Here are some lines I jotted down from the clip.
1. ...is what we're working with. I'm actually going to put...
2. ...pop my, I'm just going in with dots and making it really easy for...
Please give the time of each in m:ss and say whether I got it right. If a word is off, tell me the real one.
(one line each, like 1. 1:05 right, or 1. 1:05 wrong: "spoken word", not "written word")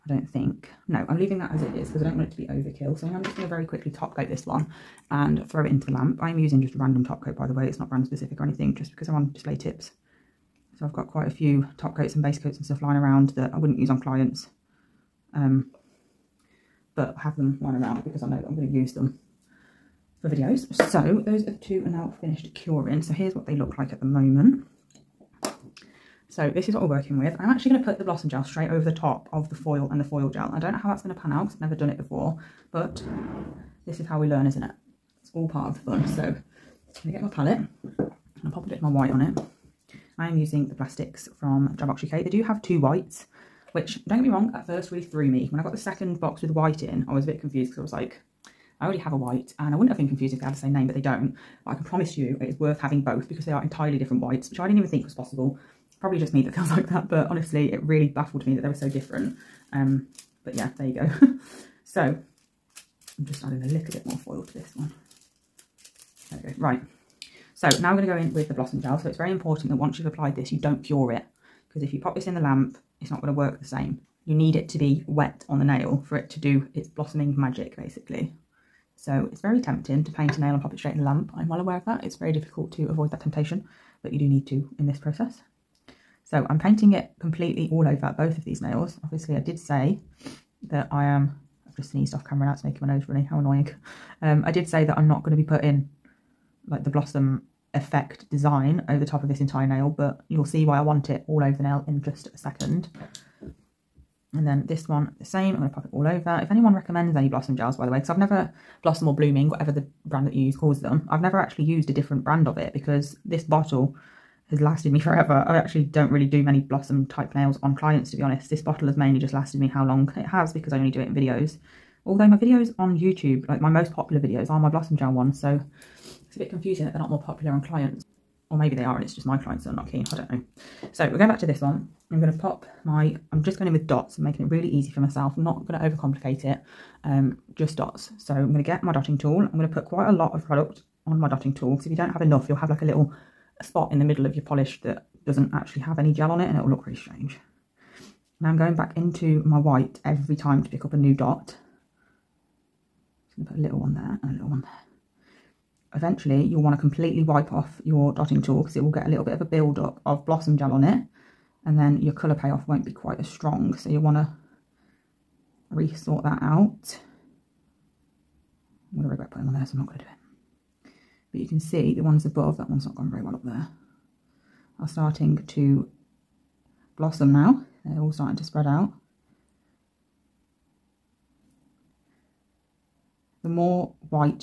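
1. 0:26 right
2. 2:12 right.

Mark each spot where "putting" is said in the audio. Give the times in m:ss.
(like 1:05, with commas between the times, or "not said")
1:35, 2:49.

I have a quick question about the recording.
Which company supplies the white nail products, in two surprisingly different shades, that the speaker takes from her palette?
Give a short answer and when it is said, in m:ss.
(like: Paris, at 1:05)
Drybox UK, at 0:41.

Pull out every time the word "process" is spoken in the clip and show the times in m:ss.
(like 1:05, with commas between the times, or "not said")
1:24.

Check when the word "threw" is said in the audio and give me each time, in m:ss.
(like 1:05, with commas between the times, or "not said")
0:45.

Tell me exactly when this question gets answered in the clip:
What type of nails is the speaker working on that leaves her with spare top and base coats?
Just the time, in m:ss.
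0:09.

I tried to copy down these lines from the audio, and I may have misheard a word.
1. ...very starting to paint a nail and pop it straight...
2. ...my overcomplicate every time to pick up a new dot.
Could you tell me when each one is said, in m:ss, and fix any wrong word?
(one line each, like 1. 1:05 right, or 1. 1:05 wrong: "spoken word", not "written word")
1. 1:19 wrong: "tempting", not "starting"
2. 2:29 wrong: "white", not "overcomplicate".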